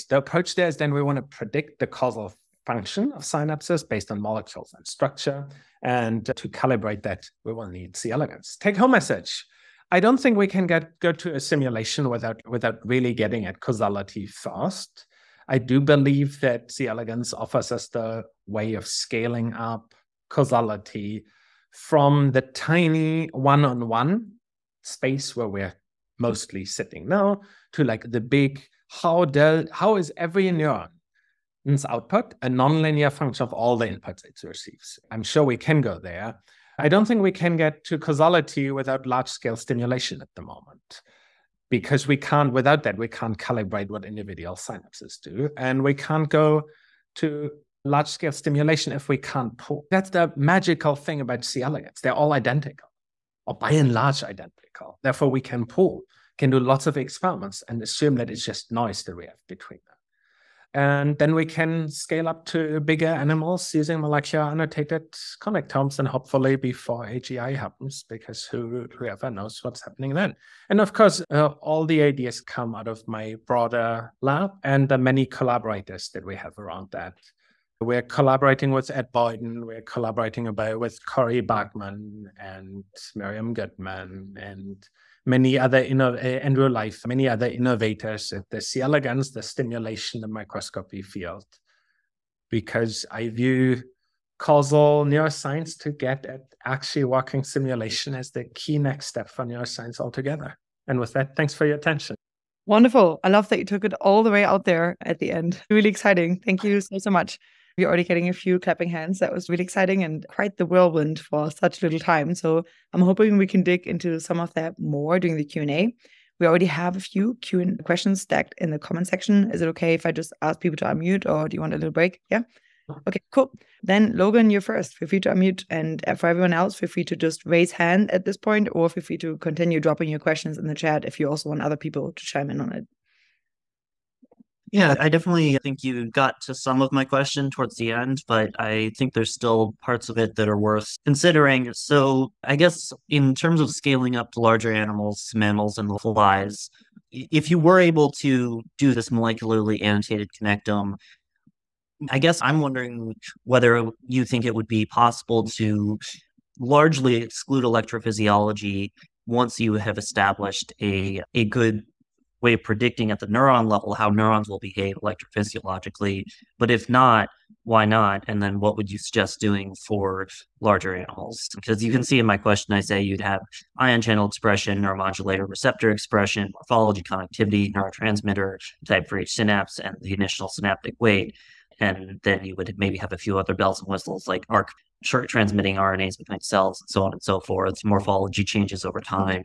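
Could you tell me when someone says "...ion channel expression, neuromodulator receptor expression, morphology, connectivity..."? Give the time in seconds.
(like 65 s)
173 s.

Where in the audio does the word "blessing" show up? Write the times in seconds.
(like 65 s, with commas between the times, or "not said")
not said.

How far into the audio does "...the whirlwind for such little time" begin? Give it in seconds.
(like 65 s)
110 s.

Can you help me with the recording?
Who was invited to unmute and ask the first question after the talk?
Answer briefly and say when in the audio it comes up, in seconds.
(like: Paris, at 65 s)
Logan, at 124 s.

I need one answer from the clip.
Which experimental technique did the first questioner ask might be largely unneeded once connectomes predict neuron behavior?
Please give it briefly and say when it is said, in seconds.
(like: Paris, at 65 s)
electrophysiology, at 157 s.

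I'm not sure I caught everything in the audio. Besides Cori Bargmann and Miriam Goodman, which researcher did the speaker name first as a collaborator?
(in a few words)
Ed Boyden.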